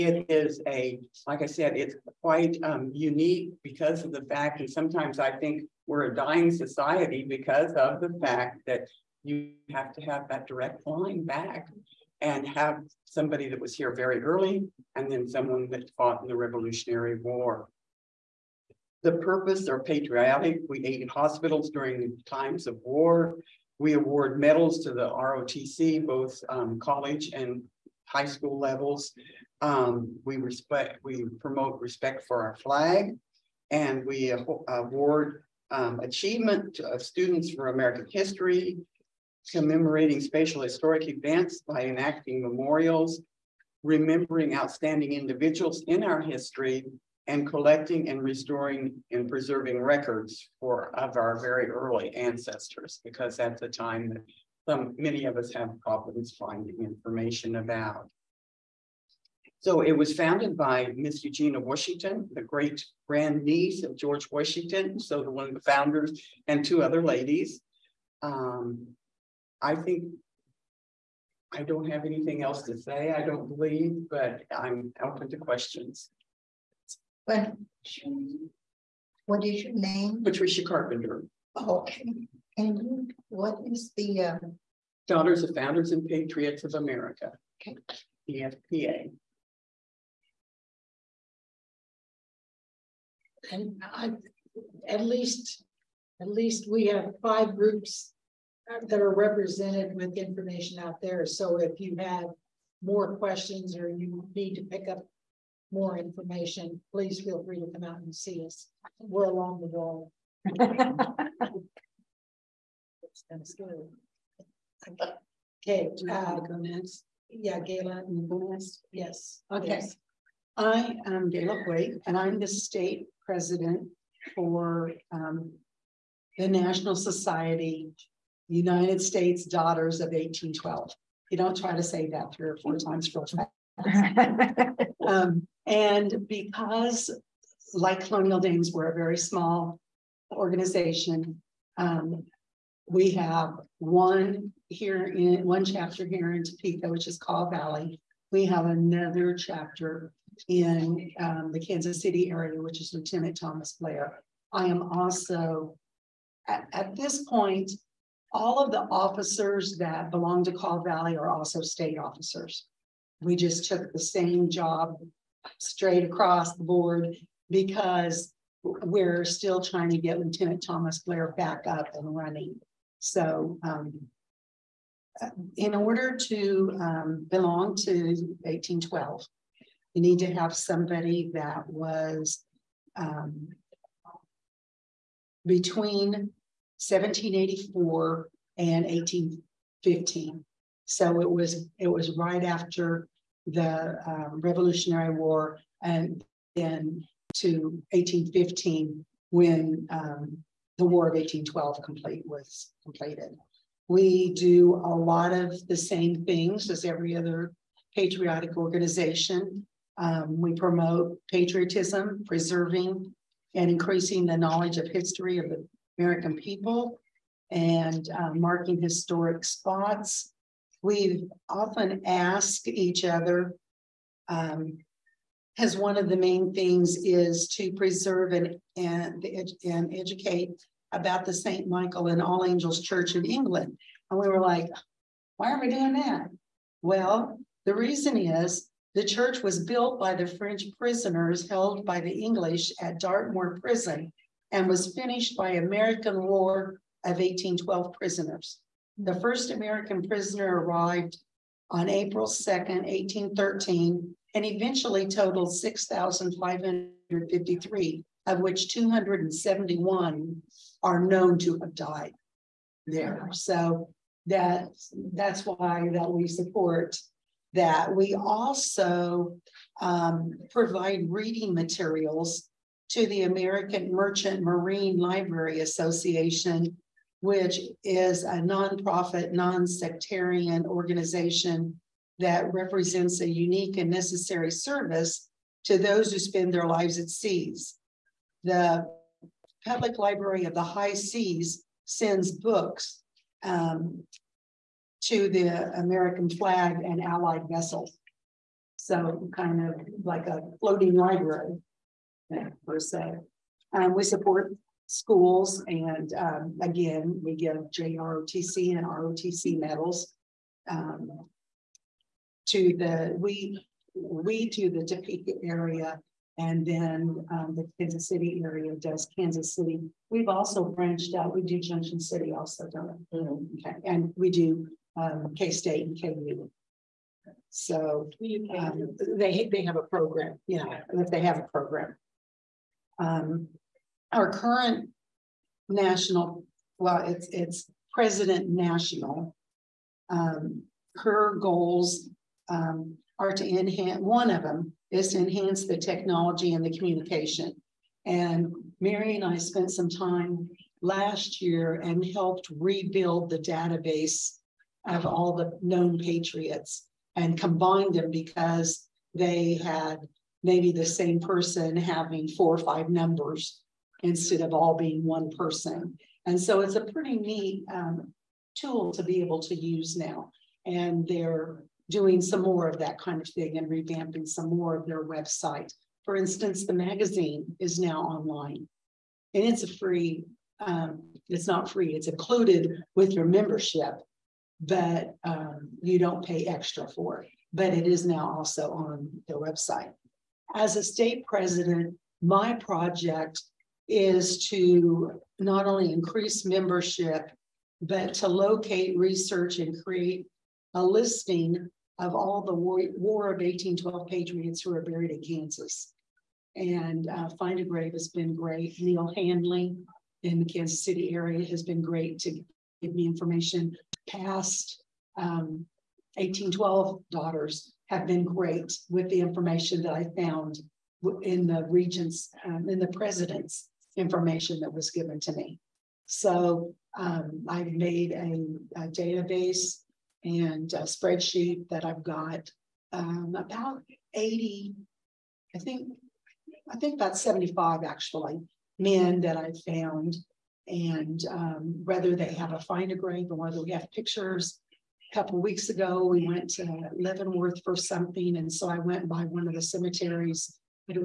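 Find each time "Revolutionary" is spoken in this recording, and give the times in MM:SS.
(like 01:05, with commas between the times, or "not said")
00:16, 03:14.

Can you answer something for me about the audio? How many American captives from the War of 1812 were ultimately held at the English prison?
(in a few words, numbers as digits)
6,553.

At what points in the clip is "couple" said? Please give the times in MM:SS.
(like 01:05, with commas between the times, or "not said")
07:25.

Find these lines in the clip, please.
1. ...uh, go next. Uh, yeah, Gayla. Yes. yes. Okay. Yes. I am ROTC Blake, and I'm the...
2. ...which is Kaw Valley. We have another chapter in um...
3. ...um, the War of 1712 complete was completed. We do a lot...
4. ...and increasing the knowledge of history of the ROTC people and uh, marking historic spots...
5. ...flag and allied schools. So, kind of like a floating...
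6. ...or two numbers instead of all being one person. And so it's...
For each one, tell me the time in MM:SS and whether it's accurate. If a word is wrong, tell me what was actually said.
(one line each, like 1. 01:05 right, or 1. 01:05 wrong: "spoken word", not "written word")
1. 01:56 wrong: "Gayla", not "ROTC"
2. 02:26 right
3. 03:19 wrong: "1812", not "1712"
4. 03:33 wrong: "American", not "ROTC"
5. 04:56 wrong: "vessels", not "schools"
6. 06:02 wrong: "five", not "two".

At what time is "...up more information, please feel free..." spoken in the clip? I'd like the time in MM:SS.
01:44.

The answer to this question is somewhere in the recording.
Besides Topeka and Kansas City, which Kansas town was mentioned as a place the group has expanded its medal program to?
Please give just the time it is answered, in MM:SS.
05:21.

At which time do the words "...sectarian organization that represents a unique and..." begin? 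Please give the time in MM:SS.
04:39.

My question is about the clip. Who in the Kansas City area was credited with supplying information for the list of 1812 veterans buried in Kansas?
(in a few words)
Neil Handley.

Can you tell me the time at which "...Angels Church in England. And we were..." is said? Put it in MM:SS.
03:52.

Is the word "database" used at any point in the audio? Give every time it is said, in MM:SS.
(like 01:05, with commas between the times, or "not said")
05:53, 07:08.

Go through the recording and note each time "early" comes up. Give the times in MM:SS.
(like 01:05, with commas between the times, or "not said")
00:14, 00:51.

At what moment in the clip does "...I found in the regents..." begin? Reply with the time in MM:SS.
06:59.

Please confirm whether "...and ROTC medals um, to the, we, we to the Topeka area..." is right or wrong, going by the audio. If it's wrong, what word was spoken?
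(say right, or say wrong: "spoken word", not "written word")
right.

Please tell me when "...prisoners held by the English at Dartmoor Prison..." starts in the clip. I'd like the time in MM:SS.
04:00.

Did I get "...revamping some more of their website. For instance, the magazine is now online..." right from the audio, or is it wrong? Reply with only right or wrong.
right.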